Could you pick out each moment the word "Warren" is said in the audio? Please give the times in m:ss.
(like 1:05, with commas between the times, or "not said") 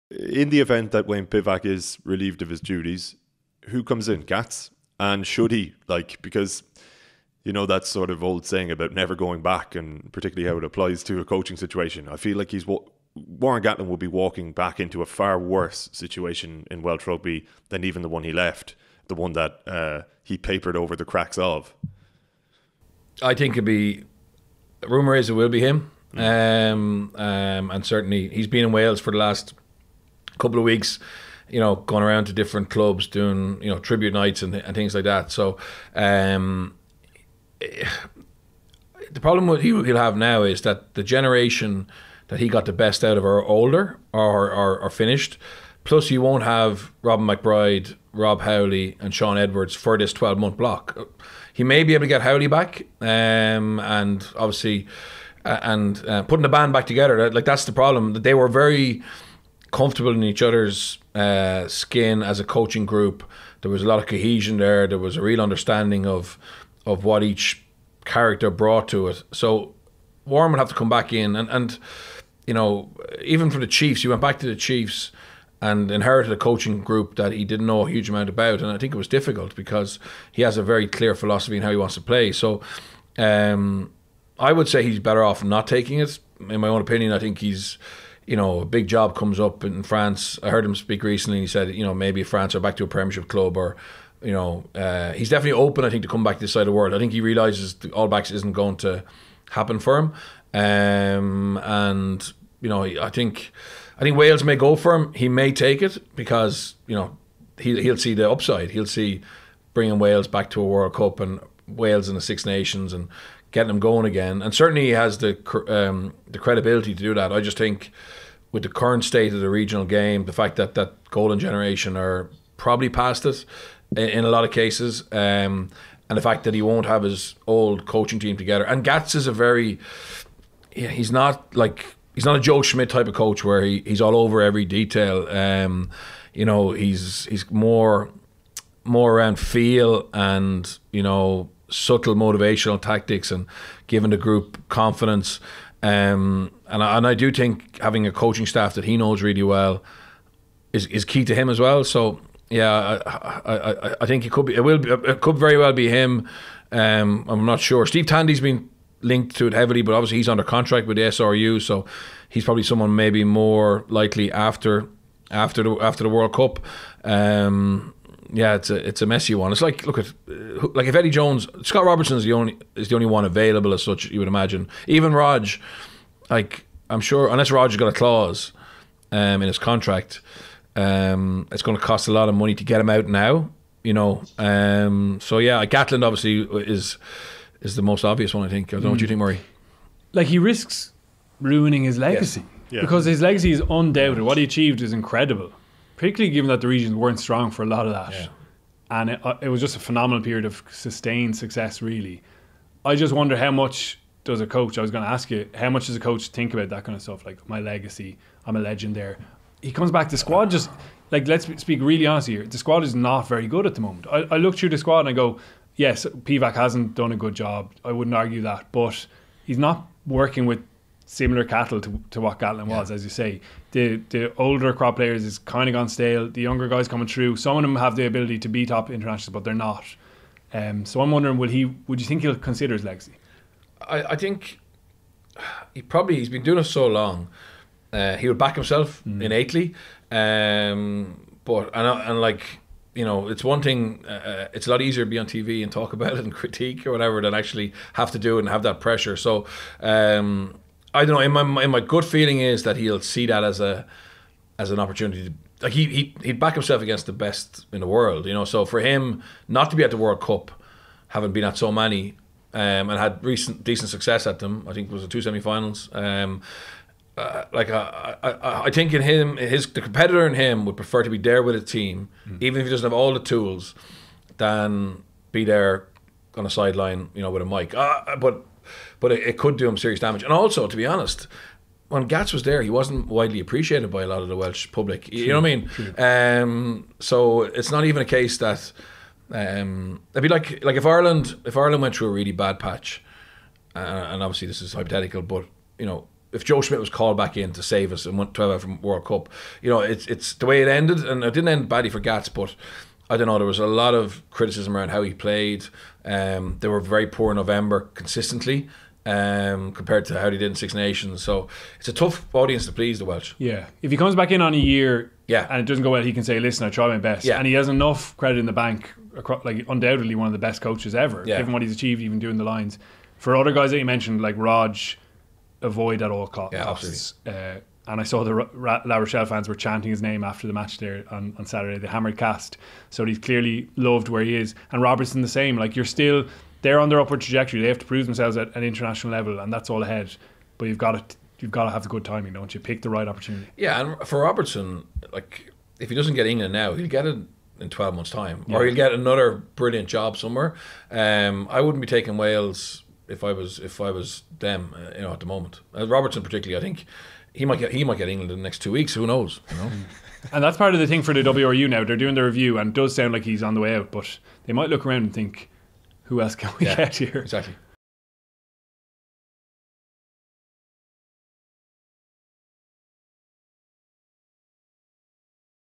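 0:13, 1:10.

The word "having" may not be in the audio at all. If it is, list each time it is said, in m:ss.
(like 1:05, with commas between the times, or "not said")
2:27, 4:21.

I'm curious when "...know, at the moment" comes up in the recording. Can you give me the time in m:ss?
5:55.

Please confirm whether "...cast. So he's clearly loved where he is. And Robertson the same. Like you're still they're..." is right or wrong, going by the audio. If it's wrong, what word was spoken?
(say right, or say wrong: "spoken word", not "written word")
right.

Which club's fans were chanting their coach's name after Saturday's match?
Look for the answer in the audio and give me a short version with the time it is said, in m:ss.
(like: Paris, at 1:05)
La Rochelle, at 5:28.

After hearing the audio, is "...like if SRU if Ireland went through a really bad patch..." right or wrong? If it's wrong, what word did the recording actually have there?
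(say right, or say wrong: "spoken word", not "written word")
wrong: "Ireland", not "SRU".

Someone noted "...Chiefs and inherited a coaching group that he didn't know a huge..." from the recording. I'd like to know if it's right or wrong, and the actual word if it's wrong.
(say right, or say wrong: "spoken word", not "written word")
right.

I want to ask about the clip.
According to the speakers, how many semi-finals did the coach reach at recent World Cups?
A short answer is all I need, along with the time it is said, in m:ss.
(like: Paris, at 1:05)
2, at 4:25.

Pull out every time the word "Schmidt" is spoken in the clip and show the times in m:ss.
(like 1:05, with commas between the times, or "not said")
2:12, 4:56.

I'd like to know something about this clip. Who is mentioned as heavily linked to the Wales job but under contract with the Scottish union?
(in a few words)
Steve Tandy.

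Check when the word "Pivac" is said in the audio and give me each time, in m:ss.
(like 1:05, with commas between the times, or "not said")
0:01, 3:36.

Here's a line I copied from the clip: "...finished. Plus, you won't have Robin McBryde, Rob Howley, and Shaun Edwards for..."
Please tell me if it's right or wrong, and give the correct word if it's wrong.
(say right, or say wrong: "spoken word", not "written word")
right.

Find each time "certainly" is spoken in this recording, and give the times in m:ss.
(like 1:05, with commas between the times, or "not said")
0:27, 1:54.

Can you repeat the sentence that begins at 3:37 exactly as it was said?
I wouldn't argue that, but he's not working with similar cattle to, to what Gatland was, as you say.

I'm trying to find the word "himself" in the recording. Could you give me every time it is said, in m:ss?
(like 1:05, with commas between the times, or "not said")
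3:58, 4:16.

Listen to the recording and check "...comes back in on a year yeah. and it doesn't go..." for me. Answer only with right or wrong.
right.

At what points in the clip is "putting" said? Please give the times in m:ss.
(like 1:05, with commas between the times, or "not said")
0:56.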